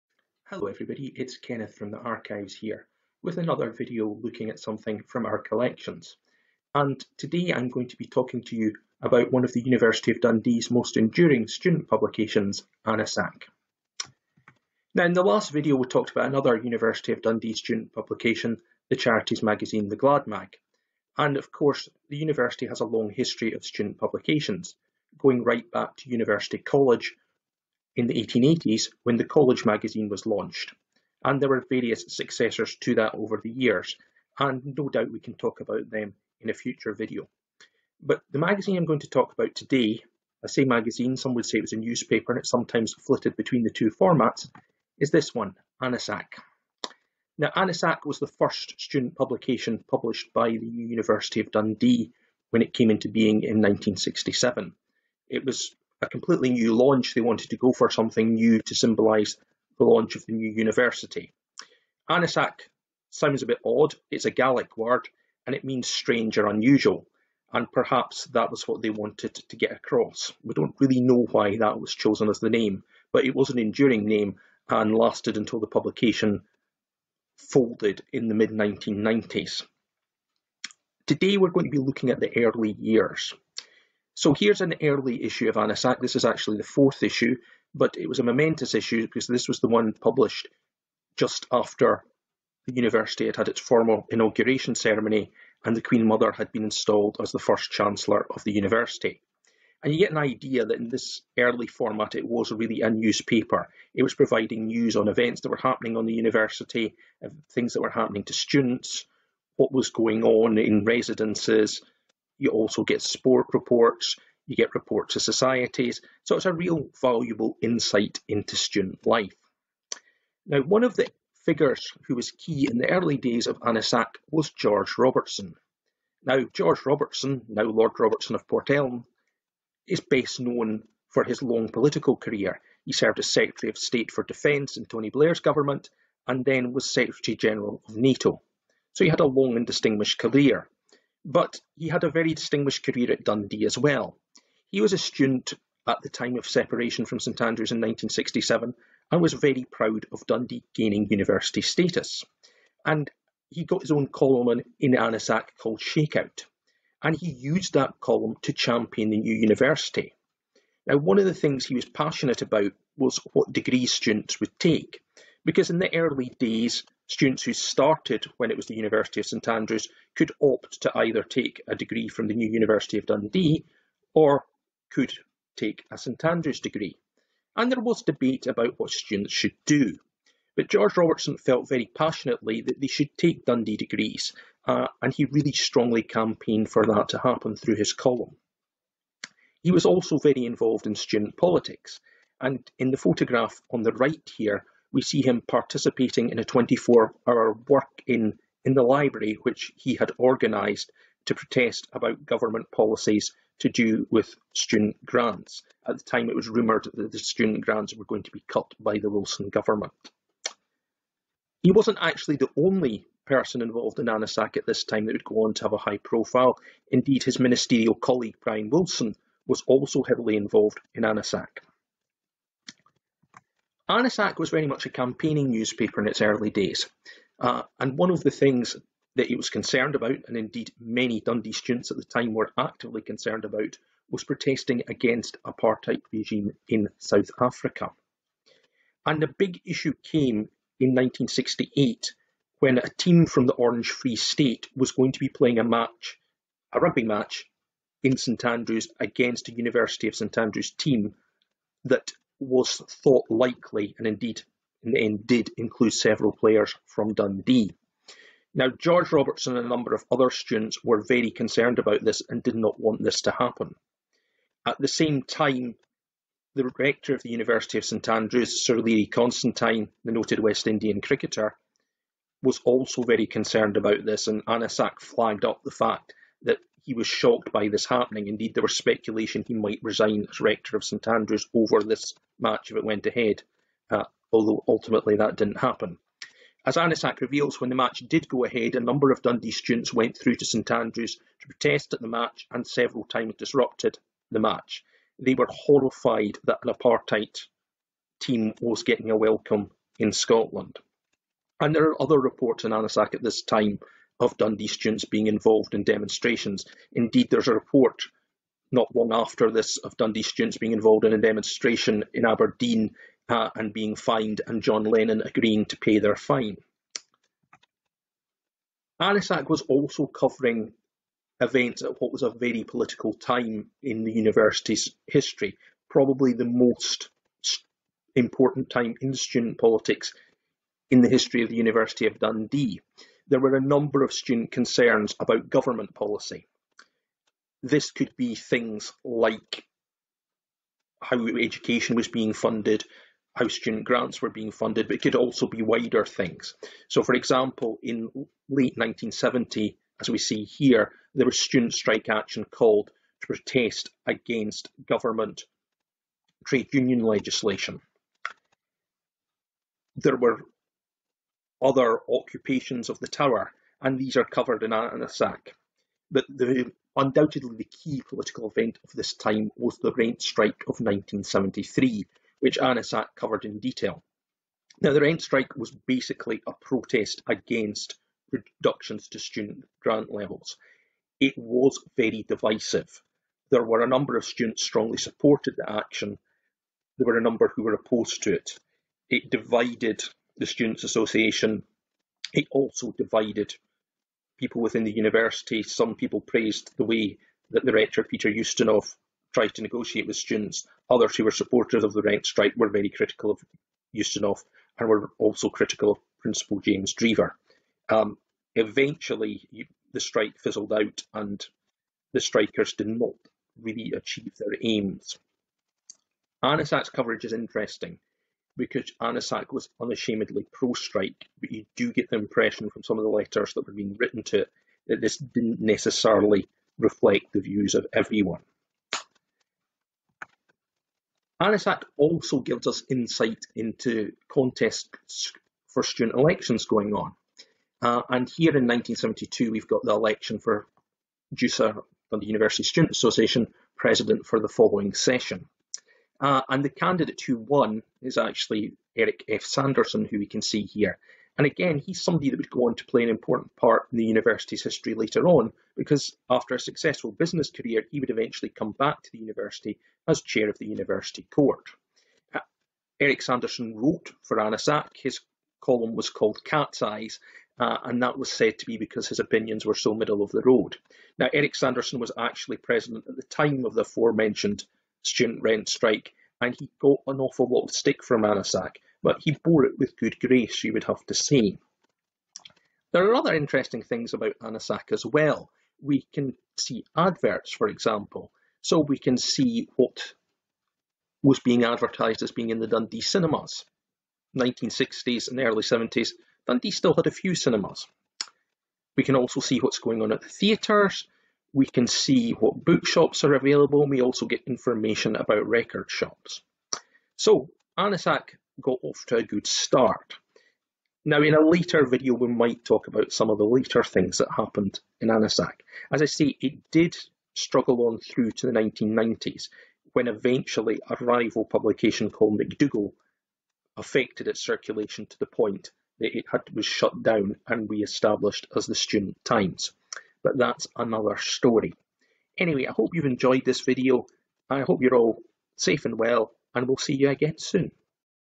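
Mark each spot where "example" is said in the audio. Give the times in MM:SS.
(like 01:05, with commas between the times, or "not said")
05:47, 08:07.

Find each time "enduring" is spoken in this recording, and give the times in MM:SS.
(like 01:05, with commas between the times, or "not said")
00:10, 01:13.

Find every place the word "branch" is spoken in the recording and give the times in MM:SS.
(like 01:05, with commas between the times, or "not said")
not said.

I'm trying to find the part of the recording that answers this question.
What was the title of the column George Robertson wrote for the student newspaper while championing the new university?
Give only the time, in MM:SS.
02:35.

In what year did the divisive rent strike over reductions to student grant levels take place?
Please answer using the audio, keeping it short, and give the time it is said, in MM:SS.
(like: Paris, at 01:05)
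1973, at 06:10.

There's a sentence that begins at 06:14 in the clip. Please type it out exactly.
Now, the rent strike was basically a protest against reductions to student grant levels.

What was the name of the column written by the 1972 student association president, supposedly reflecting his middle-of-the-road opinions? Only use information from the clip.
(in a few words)
Cat's Eyes.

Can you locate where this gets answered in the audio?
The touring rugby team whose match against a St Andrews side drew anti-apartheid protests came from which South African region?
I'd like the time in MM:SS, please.
04:03.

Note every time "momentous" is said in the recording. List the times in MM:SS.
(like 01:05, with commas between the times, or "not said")
01:28.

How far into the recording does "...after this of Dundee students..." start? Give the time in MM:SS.
05:09.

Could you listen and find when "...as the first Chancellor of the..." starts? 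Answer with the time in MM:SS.
01:37.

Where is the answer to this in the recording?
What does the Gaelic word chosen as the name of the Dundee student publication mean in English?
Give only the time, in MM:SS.
01:05.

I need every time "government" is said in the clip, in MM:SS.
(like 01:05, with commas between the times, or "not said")
02:15, 03:22, 03:29, 05:35, 05:54.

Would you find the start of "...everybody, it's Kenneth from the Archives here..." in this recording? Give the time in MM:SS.
00:00.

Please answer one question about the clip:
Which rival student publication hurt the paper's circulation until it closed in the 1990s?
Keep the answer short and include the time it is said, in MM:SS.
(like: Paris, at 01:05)
McDougall, at 08:42.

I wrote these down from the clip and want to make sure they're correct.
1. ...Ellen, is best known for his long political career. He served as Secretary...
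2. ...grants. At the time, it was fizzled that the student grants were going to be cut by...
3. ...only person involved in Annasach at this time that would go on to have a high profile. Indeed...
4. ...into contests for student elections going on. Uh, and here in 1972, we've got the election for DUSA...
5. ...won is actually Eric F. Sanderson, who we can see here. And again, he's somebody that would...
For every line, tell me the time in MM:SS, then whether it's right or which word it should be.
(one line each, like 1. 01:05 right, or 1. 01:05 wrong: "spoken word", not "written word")
1. 02:08 right
2. 03:25 wrong: "rumoured", not "fizzled"
3. 03:32 right
4. 07:13 right
5. 07:27 right.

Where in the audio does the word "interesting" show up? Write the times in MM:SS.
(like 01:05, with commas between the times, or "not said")
06:57, 08:03.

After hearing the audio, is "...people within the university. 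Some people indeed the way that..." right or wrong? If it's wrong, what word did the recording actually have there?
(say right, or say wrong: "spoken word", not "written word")
wrong: "praised", not "indeed".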